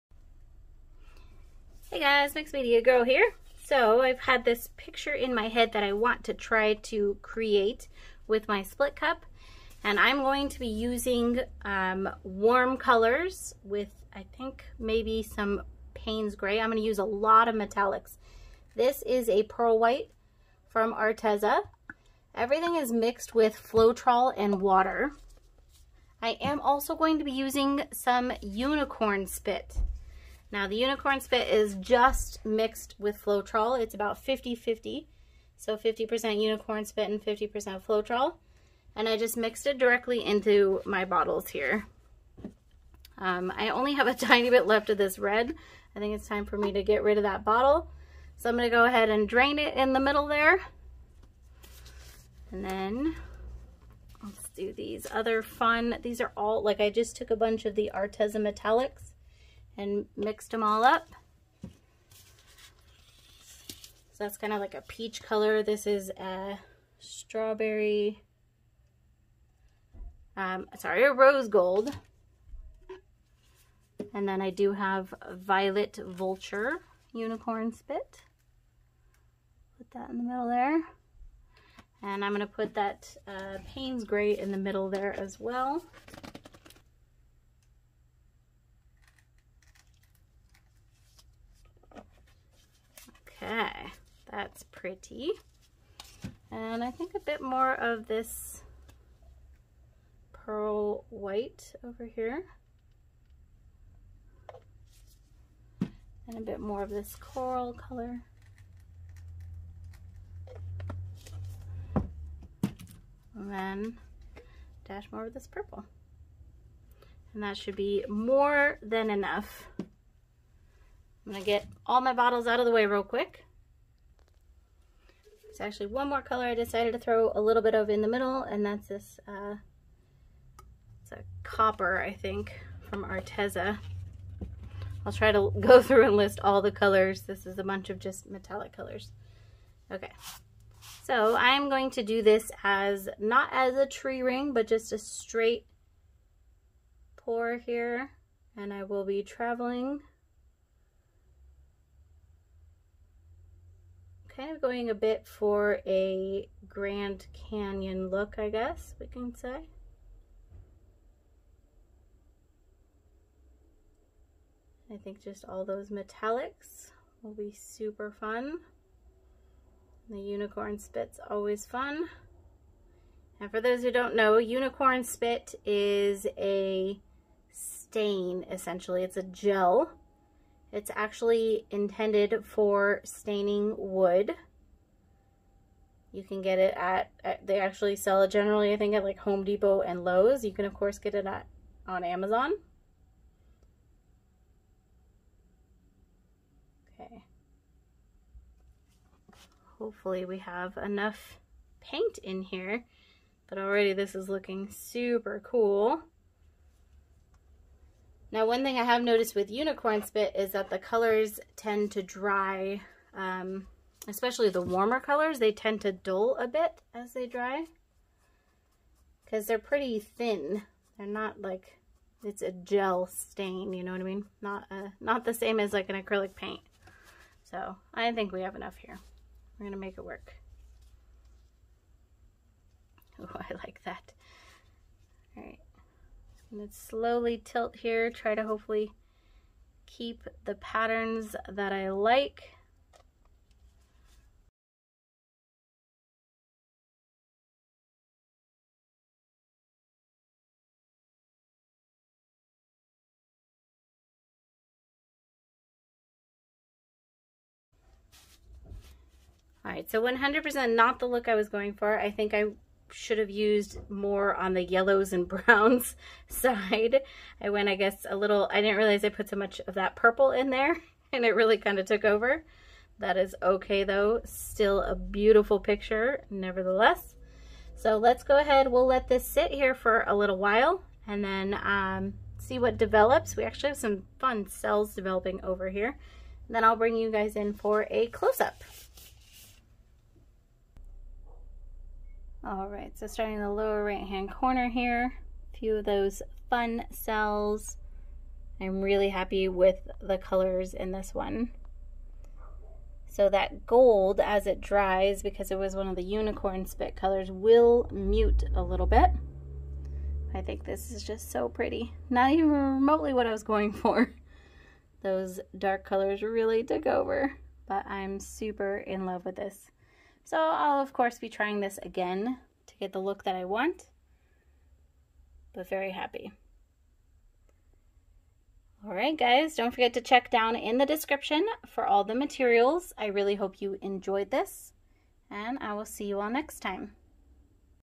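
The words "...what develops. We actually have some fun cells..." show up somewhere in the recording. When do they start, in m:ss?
4:42.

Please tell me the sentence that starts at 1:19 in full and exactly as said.
Put that in the middle there.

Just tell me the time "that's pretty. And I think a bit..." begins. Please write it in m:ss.
1:34.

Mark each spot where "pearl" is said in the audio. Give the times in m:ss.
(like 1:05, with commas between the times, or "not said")
0:19, 1:40.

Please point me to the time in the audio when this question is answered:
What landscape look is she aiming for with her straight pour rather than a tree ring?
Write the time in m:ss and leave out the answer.
2:36.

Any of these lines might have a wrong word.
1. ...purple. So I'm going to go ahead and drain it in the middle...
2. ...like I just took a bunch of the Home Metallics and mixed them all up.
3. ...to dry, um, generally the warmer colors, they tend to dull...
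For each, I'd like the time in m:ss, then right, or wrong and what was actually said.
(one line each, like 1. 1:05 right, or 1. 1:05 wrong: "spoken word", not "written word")
1. 0:47 wrong: "bottle", not "purple"
2. 0:56 wrong: "Arteza", not "Home"
3. 3:31 wrong: "especially", not "generally".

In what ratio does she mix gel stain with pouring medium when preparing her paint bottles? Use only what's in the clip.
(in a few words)
50-50.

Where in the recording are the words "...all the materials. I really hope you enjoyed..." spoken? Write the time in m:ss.
5:31.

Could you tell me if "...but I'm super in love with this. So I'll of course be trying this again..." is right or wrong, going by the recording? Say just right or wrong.
right.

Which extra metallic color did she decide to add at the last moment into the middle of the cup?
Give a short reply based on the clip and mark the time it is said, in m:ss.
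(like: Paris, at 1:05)
copper, at 2:11.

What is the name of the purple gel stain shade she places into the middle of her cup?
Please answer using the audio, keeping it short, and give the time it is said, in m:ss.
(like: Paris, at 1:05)
Violet Vulture, at 1:15.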